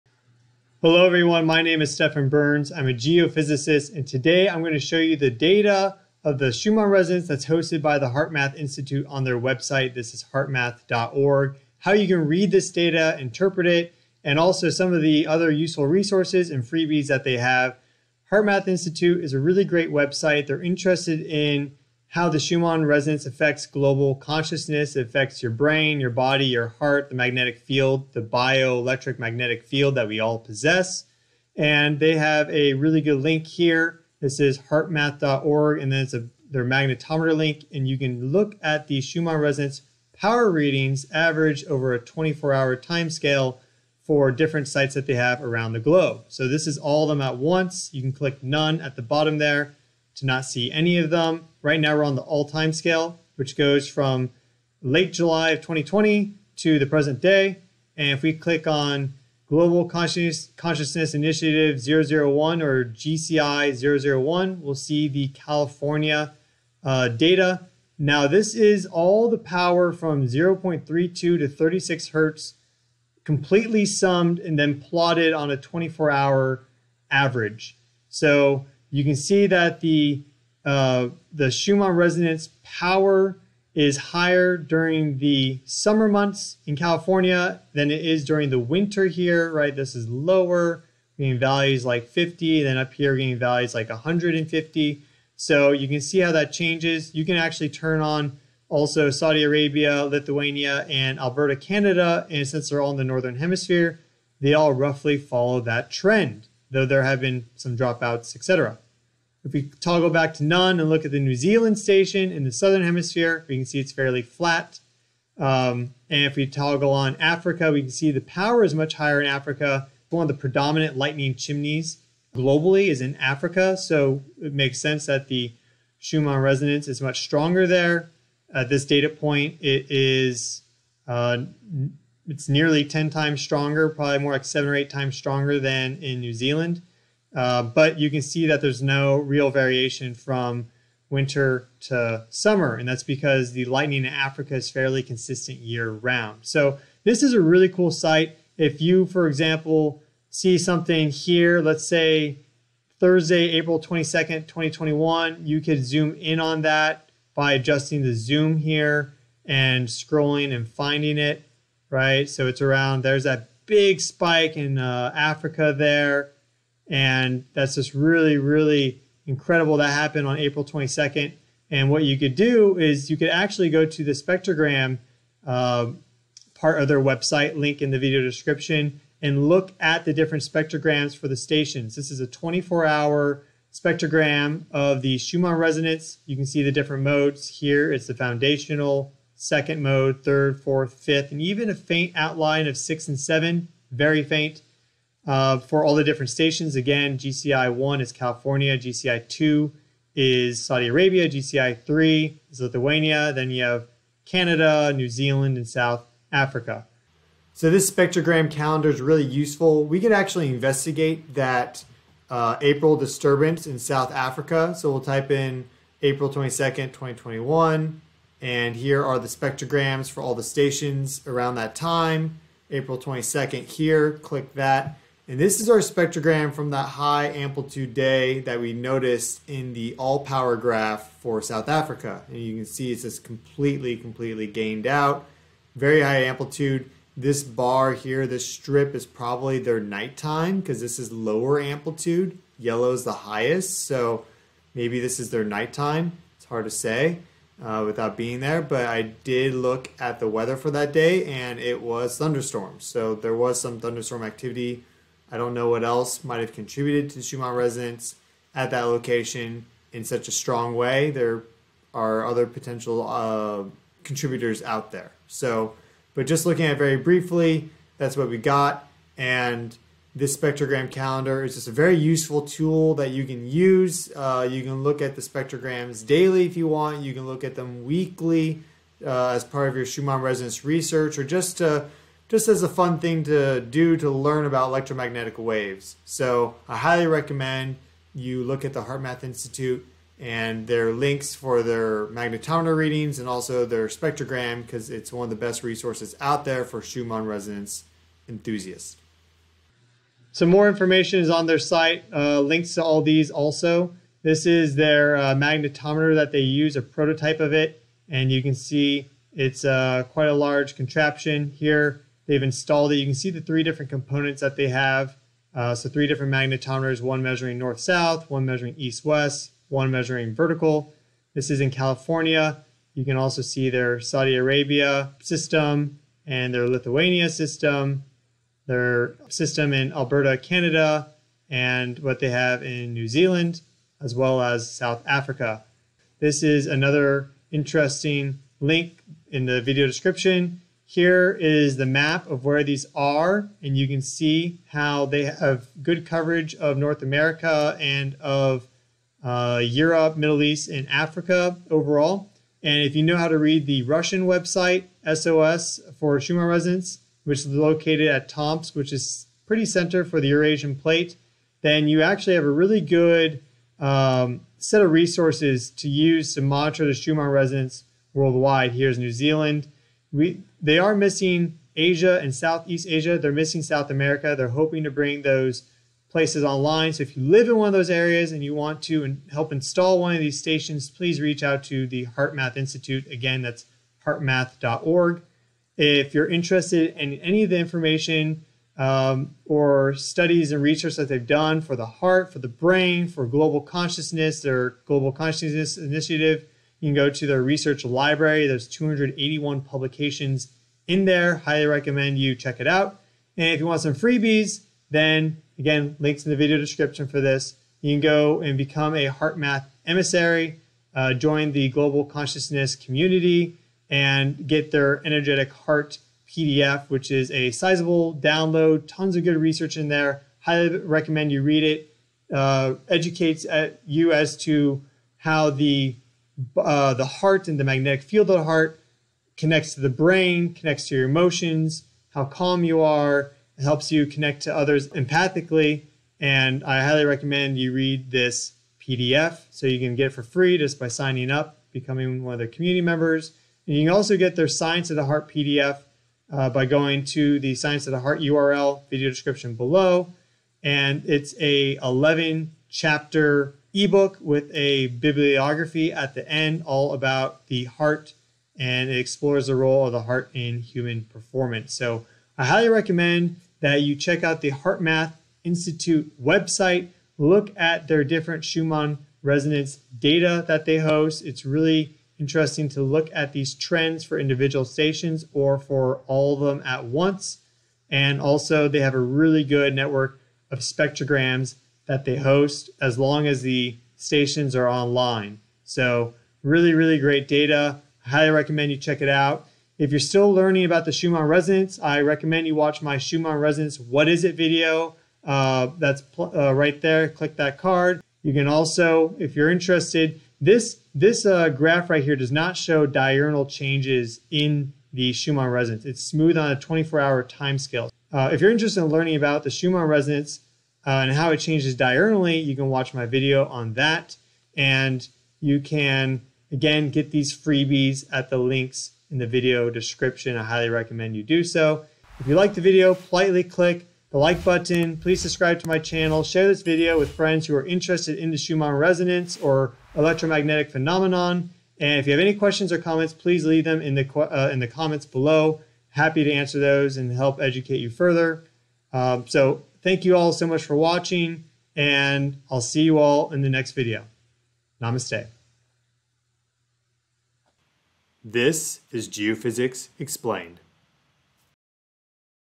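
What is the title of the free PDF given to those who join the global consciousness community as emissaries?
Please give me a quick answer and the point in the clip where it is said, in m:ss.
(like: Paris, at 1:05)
energetic heart, at 6:55.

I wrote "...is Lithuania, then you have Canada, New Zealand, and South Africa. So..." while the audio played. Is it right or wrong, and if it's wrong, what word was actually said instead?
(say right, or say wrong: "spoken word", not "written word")
right.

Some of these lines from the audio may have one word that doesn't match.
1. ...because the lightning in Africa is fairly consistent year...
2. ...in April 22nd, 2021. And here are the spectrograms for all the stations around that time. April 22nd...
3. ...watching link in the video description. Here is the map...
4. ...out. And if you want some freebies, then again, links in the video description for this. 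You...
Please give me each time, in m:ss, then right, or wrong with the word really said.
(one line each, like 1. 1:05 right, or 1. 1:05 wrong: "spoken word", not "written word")
1. 2:23 right
2. 3:35 right
3. 5:37 wrong: "interesting", not "watching"
4. 6:42 right.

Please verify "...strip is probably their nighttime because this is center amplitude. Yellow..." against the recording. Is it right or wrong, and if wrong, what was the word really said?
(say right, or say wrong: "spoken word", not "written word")
wrong: "lower", not "center".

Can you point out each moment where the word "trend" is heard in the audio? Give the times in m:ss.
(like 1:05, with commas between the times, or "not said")
1:45, 7:53.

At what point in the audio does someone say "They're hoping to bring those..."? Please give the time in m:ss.
6:14.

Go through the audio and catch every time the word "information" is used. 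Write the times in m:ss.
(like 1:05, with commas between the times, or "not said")
5:00, 6:27.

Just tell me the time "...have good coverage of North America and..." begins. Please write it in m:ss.
5:45.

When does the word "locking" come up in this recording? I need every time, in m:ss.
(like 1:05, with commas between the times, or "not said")
not said.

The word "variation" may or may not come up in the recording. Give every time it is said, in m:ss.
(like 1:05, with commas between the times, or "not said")
2:19.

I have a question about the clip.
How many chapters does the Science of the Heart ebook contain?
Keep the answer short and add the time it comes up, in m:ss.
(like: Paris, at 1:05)
11, at 7:31.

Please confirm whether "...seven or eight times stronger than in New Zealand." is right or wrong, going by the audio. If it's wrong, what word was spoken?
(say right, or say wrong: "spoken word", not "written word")
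right.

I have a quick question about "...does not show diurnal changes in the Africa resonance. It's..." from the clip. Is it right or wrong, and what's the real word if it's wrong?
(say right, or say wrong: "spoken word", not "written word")
wrong: "Schumann", not "Africa".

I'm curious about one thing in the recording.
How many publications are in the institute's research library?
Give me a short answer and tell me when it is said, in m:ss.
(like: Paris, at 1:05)
281, at 6:38.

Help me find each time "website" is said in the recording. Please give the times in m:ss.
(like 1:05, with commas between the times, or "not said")
0:09, 0:19, 2:57, 5:54, 7:46.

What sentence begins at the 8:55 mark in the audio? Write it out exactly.
Happy to answer those and help educate you further.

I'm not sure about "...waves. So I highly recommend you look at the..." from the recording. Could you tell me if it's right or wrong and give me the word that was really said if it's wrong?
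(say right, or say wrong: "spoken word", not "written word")
right.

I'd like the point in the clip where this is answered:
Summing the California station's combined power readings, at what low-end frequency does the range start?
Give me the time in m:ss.
1:10.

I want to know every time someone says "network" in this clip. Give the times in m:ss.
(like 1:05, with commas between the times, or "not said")
7:59.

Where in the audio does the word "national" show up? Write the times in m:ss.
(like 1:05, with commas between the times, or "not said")
not said.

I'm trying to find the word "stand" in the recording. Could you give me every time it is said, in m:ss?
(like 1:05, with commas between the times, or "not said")
not said.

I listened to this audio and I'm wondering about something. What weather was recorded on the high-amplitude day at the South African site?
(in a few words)
thunderstorms.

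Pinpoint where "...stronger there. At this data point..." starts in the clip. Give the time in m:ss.
2:07.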